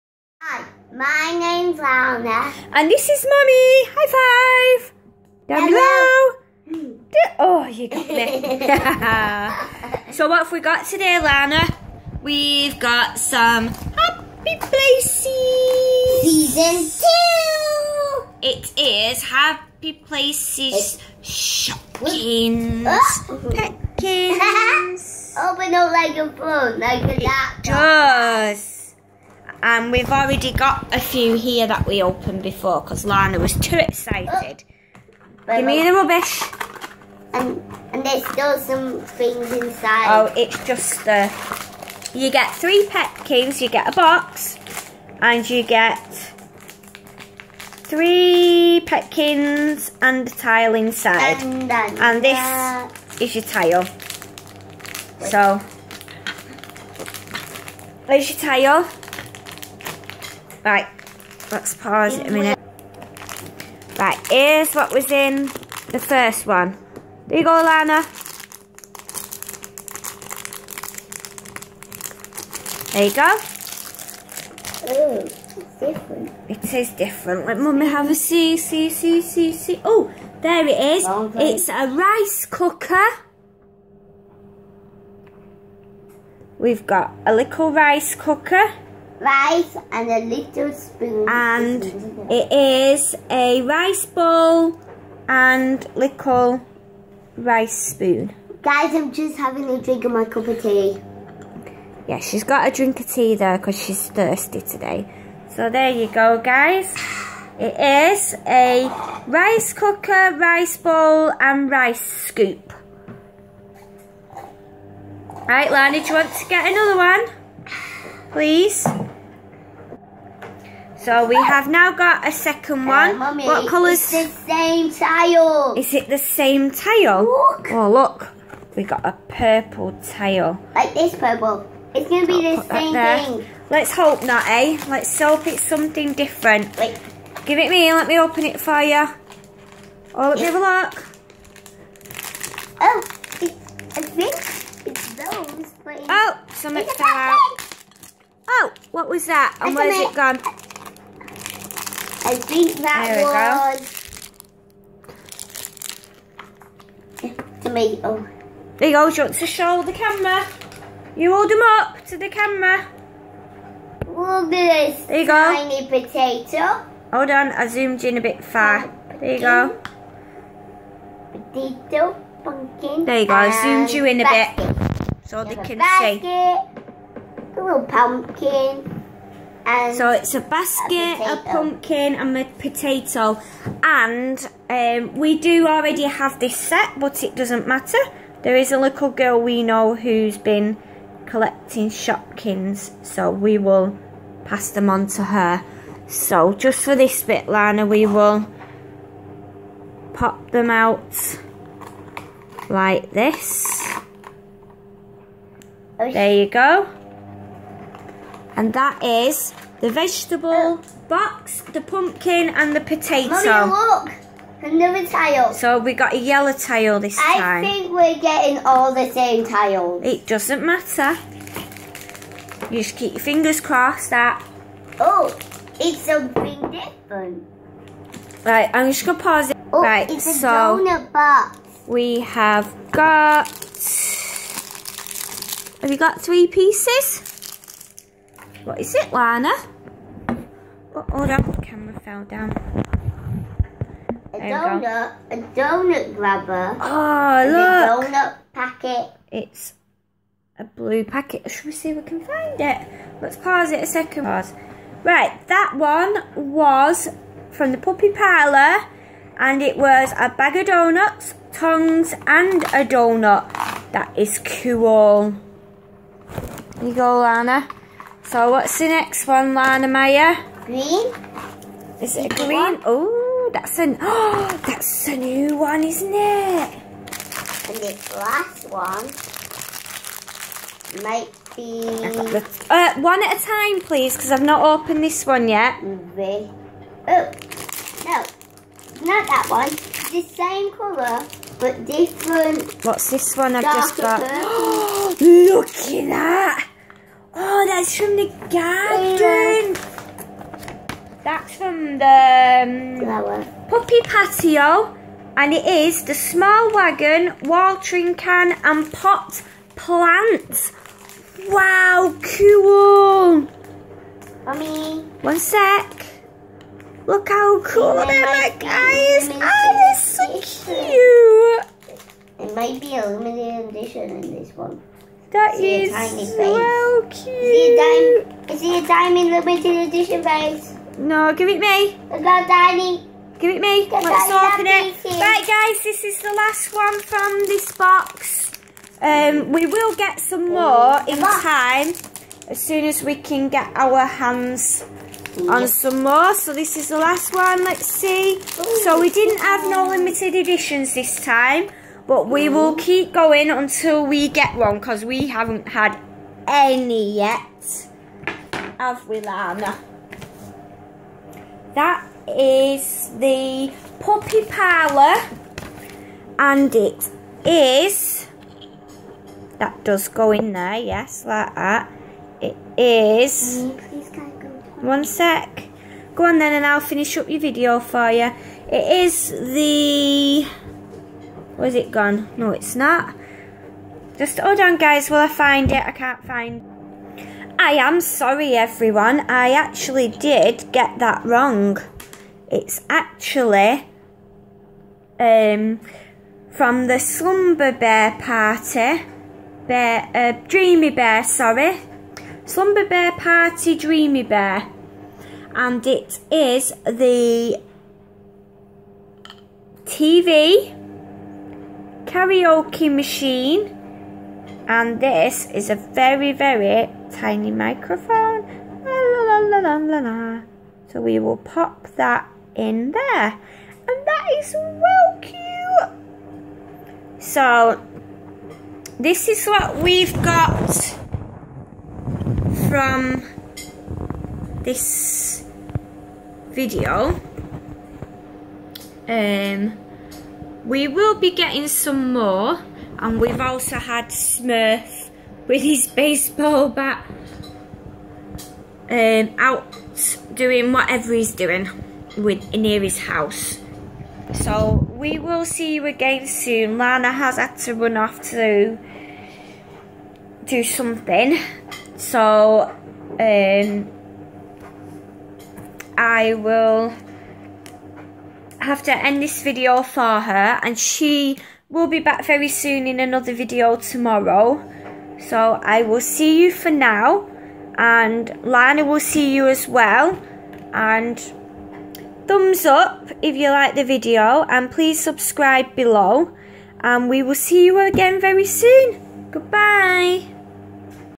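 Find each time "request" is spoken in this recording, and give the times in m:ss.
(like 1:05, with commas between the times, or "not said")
not said.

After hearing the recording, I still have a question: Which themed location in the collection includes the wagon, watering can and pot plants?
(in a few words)
Puppy Patio.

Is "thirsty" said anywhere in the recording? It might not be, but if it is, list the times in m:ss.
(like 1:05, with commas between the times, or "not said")
1:44.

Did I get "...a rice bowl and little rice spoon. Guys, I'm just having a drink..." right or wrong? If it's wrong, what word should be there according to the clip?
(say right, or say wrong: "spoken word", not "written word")
right.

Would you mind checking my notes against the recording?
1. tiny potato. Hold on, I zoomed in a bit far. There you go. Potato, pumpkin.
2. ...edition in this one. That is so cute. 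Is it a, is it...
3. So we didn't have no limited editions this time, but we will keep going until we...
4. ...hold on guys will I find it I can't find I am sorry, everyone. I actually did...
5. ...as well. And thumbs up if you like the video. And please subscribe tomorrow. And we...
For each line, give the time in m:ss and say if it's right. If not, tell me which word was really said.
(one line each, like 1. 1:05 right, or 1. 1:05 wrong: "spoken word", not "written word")
1. 2:45 right
2. 5:23 right
3. 5:48 right
4. 6:24 right
5. 7:59 wrong: "below", not "tomorrow".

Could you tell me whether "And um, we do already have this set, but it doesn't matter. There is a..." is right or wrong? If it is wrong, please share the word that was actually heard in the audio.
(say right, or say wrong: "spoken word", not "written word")
right.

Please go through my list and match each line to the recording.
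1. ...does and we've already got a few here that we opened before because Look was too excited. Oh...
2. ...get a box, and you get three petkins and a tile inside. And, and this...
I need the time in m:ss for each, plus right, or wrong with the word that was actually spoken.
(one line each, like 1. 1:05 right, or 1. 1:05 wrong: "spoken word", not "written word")
1. 0:27 wrong: "Lana", not "Look"
2. 0:43 right.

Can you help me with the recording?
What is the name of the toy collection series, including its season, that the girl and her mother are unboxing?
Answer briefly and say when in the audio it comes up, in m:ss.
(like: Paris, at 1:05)
Happy Places Season 2, at 0:13.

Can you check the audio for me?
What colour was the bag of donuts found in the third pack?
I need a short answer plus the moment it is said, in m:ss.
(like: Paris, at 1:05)
Blue, at 4:10.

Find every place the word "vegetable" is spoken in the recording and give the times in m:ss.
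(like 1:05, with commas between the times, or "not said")
3:29.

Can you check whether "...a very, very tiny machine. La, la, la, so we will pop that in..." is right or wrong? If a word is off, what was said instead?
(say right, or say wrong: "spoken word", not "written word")
wrong: "microphone", not "machine".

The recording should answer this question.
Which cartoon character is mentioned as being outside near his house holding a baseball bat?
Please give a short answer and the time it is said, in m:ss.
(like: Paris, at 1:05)
Smurf, at 7:24.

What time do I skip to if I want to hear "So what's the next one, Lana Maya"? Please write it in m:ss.
4:28.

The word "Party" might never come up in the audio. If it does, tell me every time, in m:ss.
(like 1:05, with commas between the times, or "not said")
6:38, 6:43.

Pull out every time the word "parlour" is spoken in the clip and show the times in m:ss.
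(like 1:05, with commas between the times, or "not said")
4:18, 6:04.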